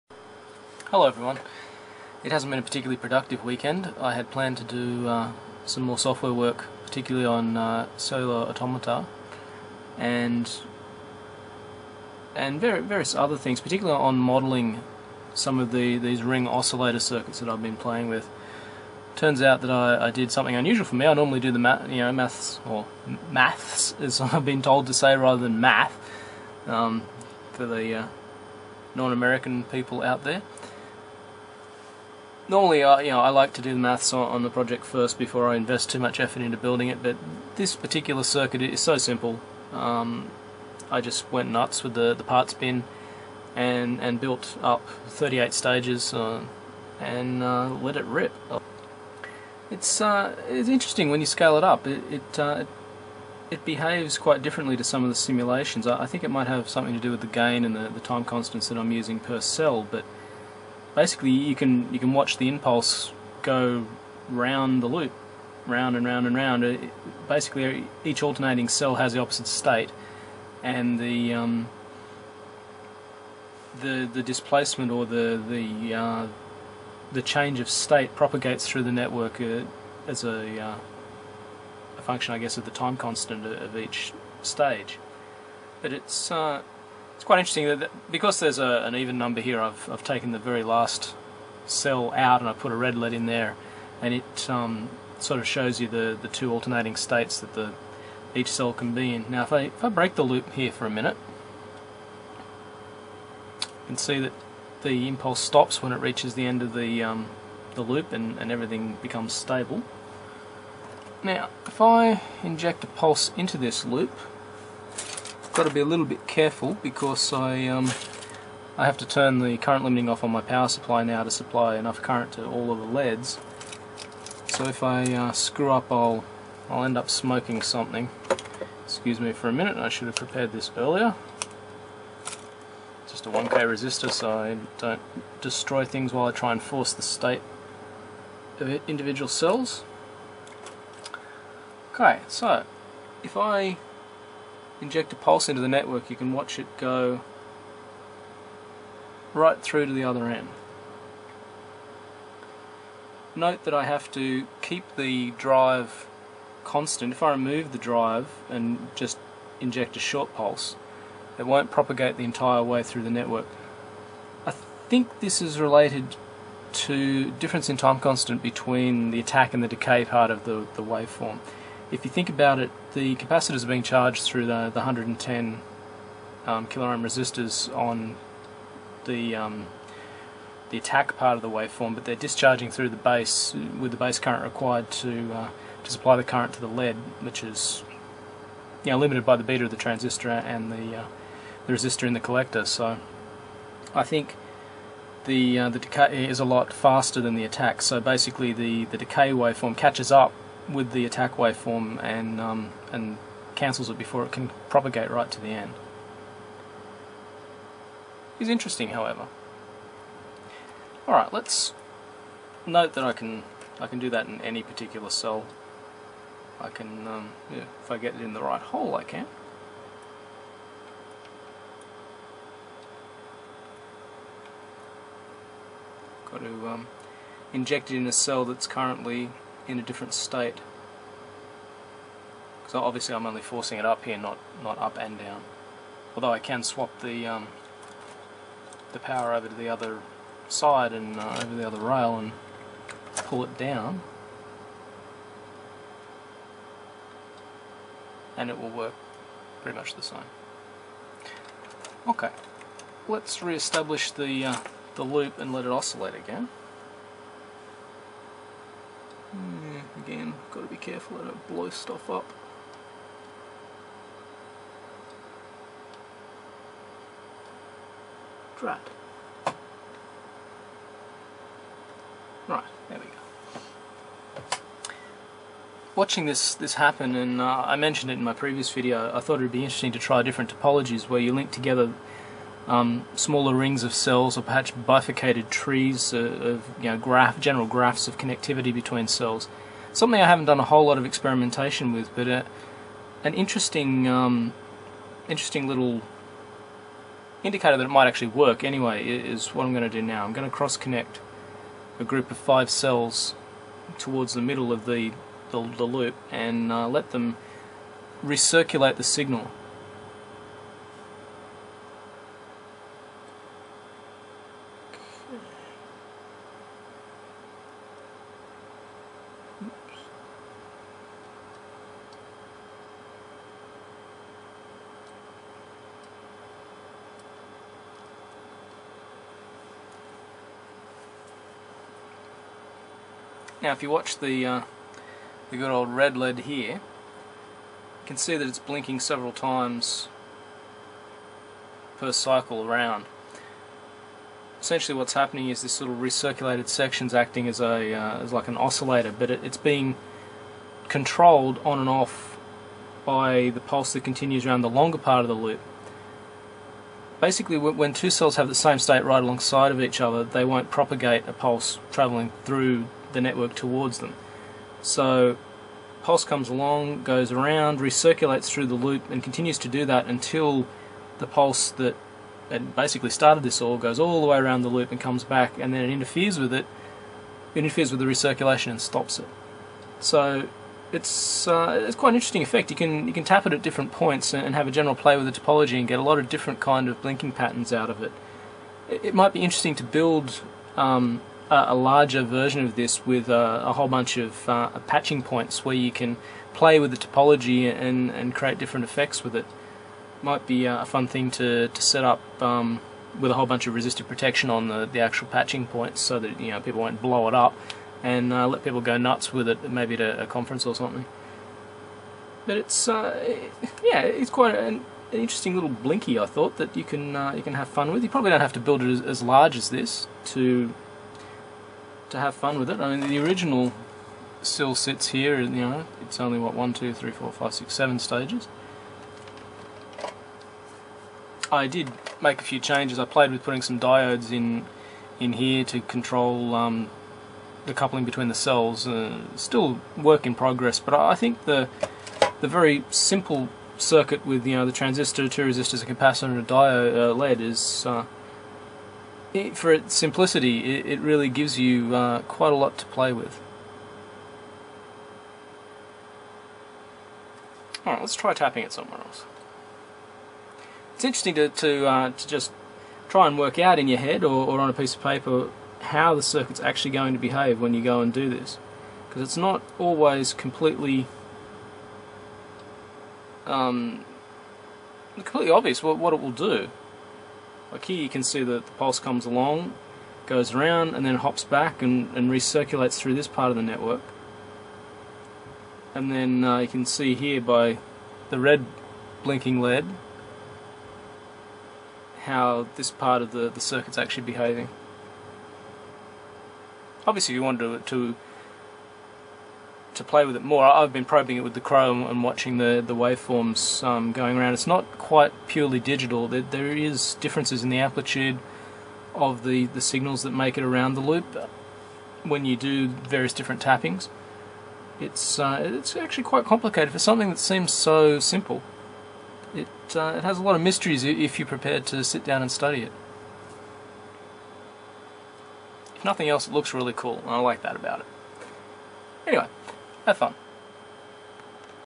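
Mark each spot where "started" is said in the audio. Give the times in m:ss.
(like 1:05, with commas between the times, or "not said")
6:13.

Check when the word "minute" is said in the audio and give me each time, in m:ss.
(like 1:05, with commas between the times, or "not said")
1:40, 2:09.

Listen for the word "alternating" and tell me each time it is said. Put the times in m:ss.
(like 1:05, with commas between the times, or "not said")
1:08, 1:36.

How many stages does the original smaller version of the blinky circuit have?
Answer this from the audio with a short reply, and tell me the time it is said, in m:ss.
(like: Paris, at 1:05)
7, at 7:07.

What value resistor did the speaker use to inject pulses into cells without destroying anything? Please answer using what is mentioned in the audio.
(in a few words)
1k.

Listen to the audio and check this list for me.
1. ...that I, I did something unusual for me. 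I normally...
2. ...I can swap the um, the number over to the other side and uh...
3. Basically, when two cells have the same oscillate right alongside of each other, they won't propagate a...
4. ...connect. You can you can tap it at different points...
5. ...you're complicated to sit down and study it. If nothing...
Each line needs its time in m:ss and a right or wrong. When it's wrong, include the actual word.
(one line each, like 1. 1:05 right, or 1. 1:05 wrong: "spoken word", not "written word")
1. 0:19 right
2. 3:56 wrong: "power", not "number"
3. 5:57 wrong: "state", not "oscillate"
4. 6:22 wrong: "effect", not "connect"
5. 8:41 wrong: "prepared", not "complicated".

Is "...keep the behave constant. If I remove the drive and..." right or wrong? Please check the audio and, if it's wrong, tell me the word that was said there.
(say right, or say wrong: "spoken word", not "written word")
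wrong: "drive", not "behave".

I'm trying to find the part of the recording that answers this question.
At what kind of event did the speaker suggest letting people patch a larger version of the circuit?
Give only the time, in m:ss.
6:50.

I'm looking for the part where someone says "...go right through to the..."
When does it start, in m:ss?
2:26.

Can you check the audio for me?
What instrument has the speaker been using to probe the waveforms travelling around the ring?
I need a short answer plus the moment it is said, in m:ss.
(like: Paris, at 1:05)
CRO, at 8:21.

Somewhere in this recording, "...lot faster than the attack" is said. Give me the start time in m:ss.
3:16.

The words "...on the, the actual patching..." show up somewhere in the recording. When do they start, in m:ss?
6:44.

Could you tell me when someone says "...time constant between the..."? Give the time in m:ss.
2:47.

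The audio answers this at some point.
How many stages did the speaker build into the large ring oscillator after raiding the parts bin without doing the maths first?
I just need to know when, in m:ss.
0:45.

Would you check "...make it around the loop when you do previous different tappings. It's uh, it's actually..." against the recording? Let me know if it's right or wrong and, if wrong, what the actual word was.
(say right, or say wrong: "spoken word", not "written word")
wrong: "various", not "previous".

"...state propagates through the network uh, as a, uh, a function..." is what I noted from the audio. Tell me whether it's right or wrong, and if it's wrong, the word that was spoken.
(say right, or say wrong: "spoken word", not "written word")
right.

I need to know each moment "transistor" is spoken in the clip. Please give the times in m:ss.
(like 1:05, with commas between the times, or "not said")
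3:09, 7:24.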